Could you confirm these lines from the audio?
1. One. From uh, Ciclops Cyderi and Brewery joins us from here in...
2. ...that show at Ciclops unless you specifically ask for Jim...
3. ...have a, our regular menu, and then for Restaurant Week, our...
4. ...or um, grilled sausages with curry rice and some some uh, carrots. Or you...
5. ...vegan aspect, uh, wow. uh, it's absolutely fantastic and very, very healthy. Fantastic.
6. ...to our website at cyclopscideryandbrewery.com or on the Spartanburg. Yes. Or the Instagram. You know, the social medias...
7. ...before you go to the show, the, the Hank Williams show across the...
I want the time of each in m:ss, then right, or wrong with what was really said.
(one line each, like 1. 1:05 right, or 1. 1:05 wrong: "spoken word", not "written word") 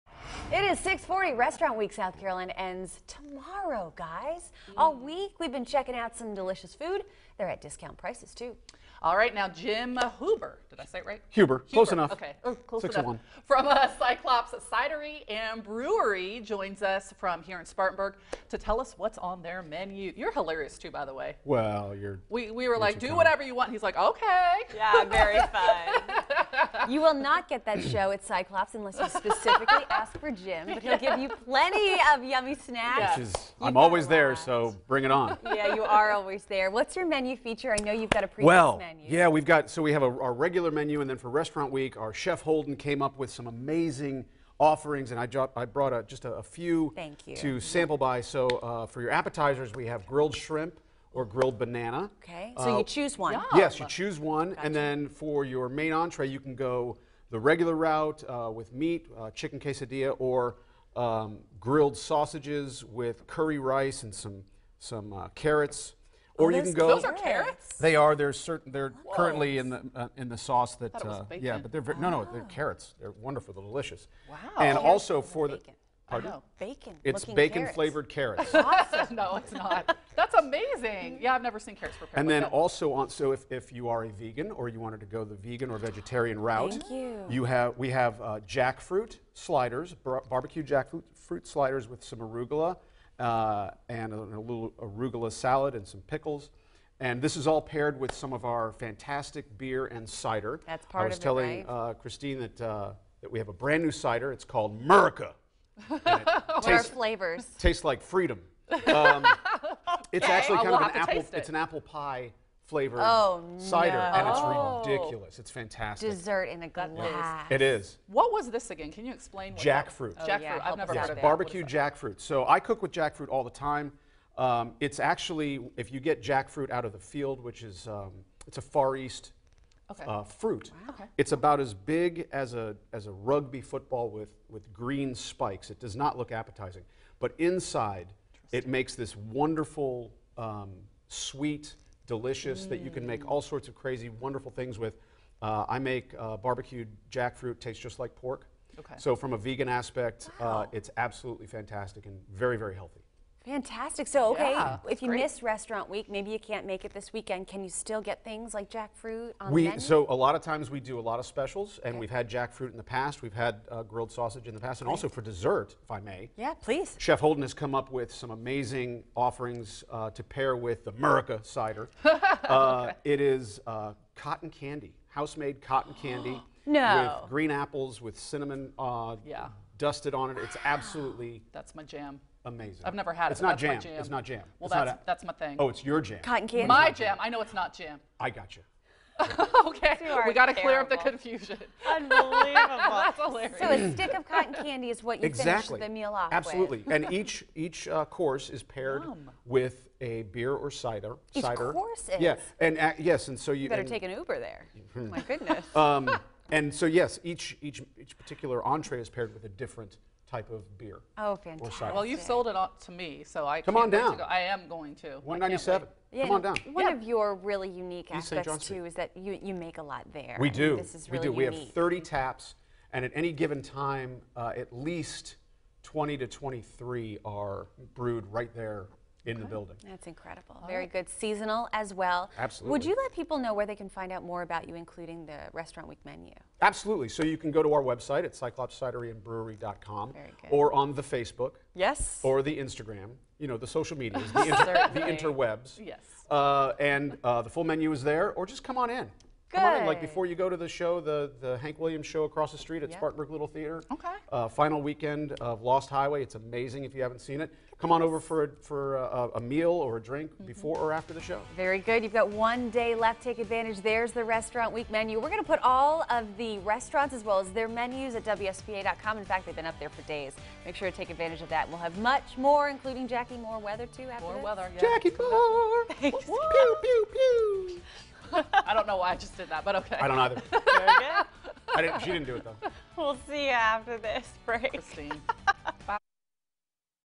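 1. 0:13 right
2. 0:27 right
3. 0:39 right
4. 1:00 right
5. 2:29 right
6. 3:57 wrong: "Facebook", not "Spartanburg"
7. 4:10 right.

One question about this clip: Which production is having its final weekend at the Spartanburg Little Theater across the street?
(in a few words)
Lost Highway.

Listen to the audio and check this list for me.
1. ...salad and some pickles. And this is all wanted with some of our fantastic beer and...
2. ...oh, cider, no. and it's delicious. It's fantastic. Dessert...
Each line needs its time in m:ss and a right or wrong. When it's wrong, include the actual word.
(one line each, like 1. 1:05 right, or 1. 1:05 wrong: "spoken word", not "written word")
1. 1:35 wrong: "paired", not "wanted"
2. 1:53 wrong: "ridiculous", not "delicious".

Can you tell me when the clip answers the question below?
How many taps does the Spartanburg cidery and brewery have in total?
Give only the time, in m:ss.
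3:41.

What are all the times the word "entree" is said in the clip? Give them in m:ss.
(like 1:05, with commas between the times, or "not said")
0:55, 3:28.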